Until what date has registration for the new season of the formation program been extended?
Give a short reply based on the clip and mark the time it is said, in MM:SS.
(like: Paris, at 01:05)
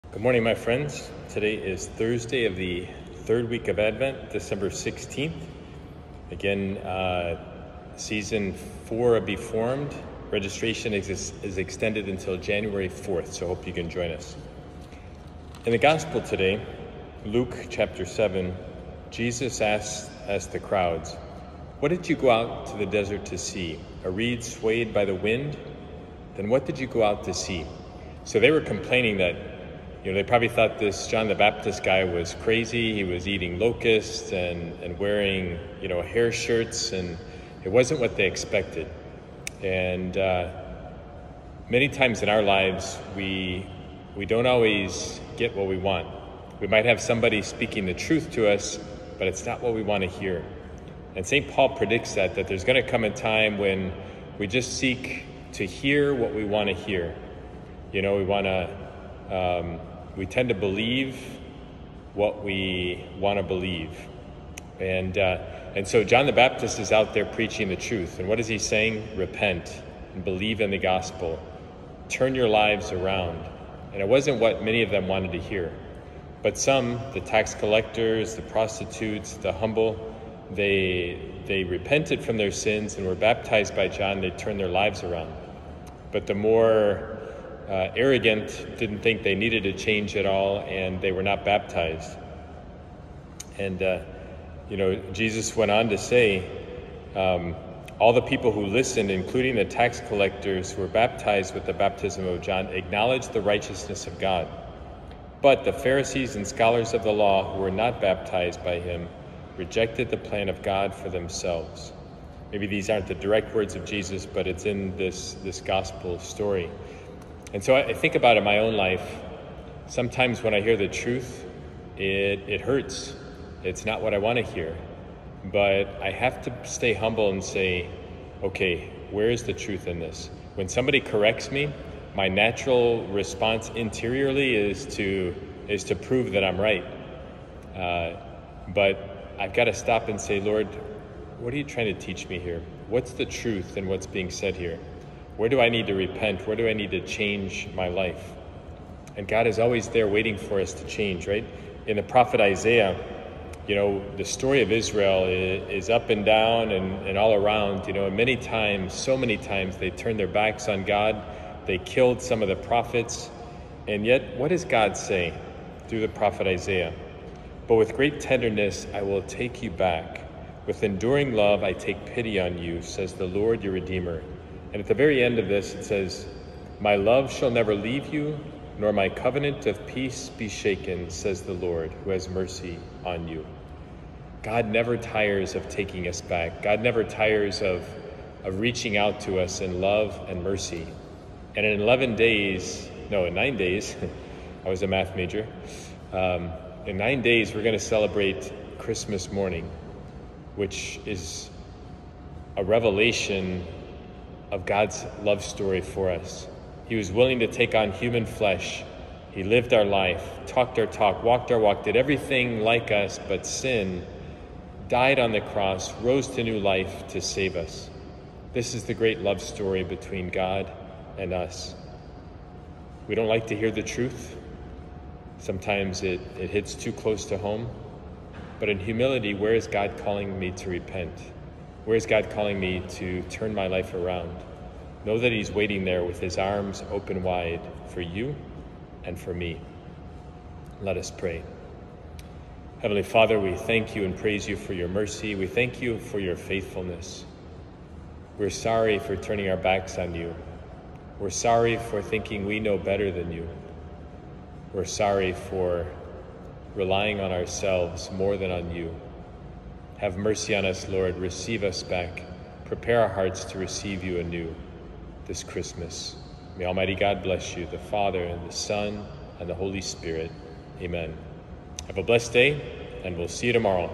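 January 4th, at 00:12.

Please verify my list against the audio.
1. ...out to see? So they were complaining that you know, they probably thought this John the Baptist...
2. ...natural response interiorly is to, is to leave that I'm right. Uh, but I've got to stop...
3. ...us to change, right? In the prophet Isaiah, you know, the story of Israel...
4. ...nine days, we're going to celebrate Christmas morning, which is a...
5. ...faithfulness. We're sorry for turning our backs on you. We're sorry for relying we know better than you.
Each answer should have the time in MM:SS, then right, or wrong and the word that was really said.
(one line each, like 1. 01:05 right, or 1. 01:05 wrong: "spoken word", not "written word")
1. 00:27 right
2. 02:12 wrong: "prove", not "leave"
3. 02:30 right
4. 03:16 right
5. 04:06 wrong: "thinking", not "relying".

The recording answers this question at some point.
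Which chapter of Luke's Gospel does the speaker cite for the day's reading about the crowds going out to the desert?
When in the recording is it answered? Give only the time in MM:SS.
00:17.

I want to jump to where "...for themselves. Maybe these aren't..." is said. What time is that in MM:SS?
01:50.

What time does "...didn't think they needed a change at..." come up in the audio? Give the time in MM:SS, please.
01:28.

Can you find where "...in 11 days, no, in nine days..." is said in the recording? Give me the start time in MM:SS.
03:11.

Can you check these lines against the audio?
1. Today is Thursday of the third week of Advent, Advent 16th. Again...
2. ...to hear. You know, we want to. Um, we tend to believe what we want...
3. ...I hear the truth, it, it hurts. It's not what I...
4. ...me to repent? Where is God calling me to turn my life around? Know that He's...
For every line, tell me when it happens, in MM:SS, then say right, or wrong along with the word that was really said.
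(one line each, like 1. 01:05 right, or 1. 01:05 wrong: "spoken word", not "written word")
1. 00:01 wrong: "December", not "Advent"
2. 00:56 right
3. 02:00 right
4. 03:50 right.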